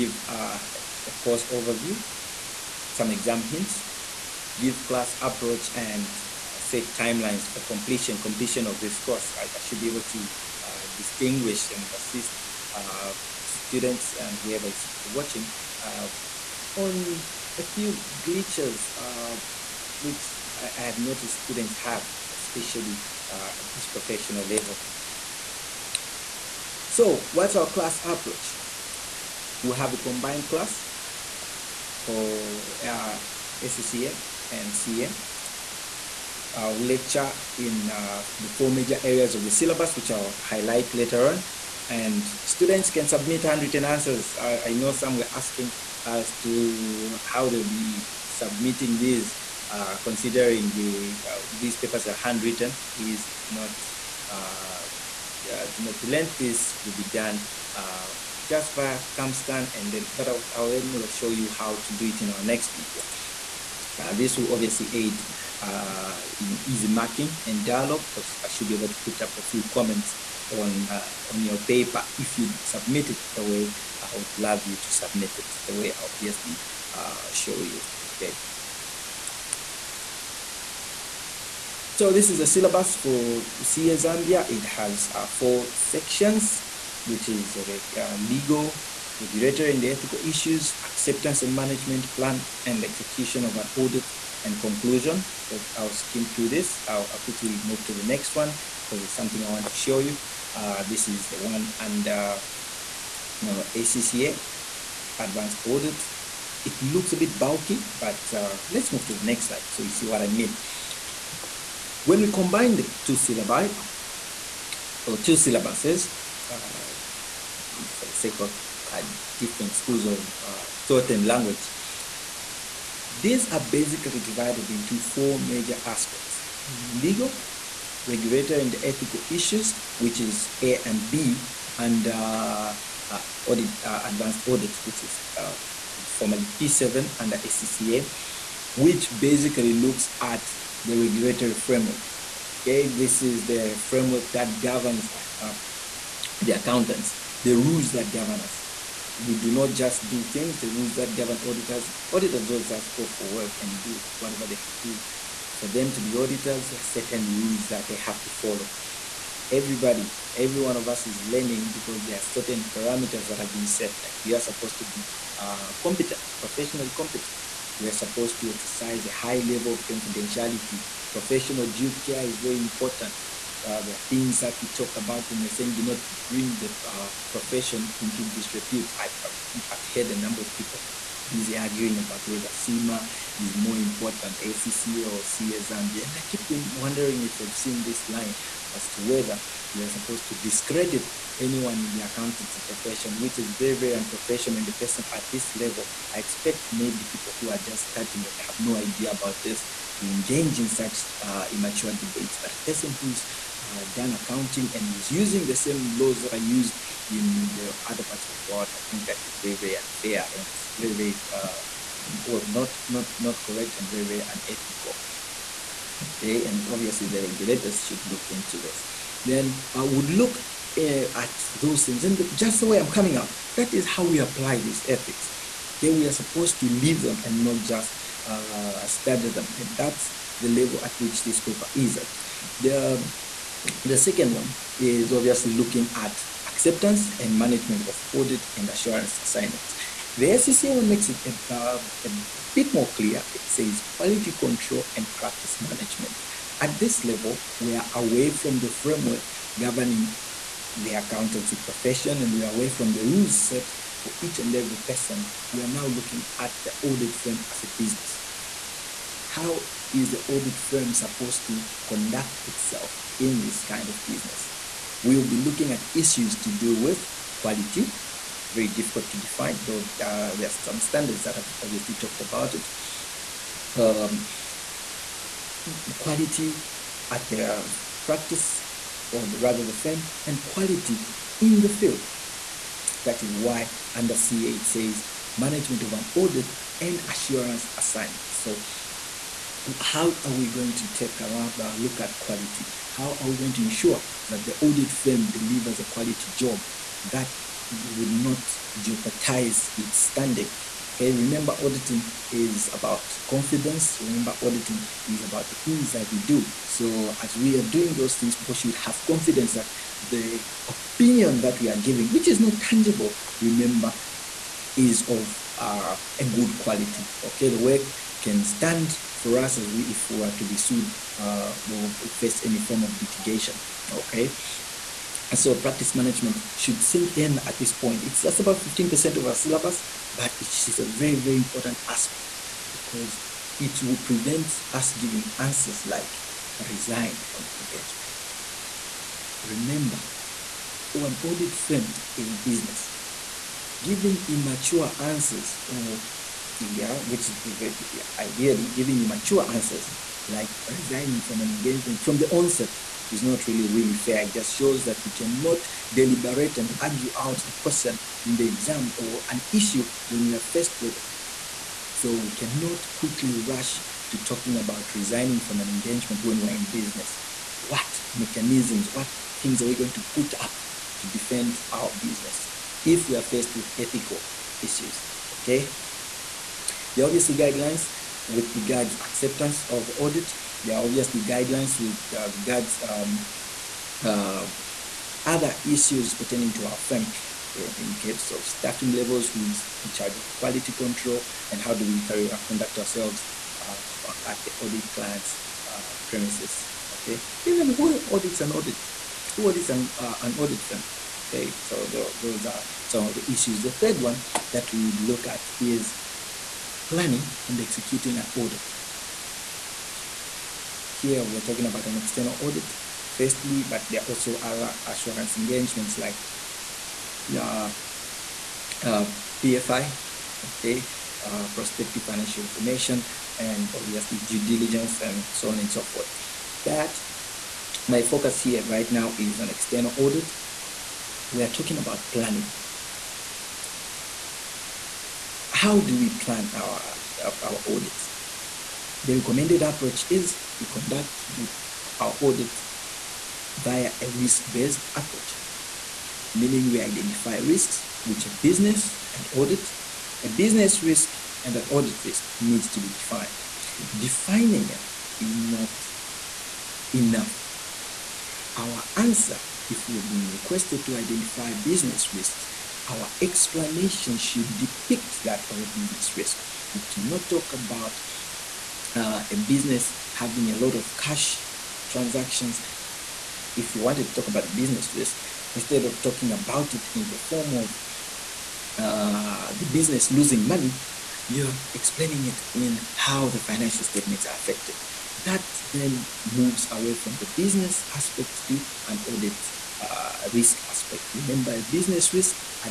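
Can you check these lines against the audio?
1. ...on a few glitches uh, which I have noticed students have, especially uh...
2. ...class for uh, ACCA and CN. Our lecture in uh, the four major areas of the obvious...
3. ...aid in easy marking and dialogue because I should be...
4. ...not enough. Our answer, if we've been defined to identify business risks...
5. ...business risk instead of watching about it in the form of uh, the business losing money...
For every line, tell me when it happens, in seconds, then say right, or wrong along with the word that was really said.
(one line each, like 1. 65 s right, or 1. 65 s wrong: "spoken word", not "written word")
1. 16 s right
2. 30 s wrong: "syllabus", not "obvious"
3. 64 s right
4. 455 s wrong: "requested", not "defined"
5. 474 s wrong: "talking", not "watching".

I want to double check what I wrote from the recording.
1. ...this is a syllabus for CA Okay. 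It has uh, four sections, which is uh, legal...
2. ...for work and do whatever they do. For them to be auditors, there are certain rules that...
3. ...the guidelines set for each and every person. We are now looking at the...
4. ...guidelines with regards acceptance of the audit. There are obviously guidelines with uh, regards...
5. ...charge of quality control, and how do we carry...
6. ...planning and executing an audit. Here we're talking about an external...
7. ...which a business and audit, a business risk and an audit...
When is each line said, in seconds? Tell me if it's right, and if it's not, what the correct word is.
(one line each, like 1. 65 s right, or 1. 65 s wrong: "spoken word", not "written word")
1. 82 s wrong: "Zambia", not "Okay"
2. 153 s right
3. 252 s wrong: "rules", not "guidelines"
4. 377 s right
5. 389 s right
6. 406 s right
7. 448 s right.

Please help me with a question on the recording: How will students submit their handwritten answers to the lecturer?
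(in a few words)
Via scan.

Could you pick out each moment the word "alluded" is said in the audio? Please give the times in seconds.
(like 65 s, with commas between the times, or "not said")
not said.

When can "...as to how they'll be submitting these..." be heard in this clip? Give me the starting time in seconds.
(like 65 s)
46 s.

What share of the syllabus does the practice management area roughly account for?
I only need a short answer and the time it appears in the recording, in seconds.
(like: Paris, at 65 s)
15%, at 328 s.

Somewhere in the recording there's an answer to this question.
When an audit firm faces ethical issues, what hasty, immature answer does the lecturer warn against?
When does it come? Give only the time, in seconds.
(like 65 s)
336 s.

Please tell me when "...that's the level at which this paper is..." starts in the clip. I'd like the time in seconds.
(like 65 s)
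229 s.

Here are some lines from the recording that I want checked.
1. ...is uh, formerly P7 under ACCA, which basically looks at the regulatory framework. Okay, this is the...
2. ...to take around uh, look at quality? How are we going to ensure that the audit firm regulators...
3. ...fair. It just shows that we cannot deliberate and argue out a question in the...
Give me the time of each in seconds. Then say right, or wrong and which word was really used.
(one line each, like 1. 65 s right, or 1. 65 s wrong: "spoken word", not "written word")
1. 135 s right
2. 290 s wrong: "delivers", not "regulators"
3. 353 s right.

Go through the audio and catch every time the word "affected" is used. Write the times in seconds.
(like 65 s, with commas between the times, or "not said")
484 s.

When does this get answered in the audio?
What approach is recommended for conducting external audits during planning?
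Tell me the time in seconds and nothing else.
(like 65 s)
444 s.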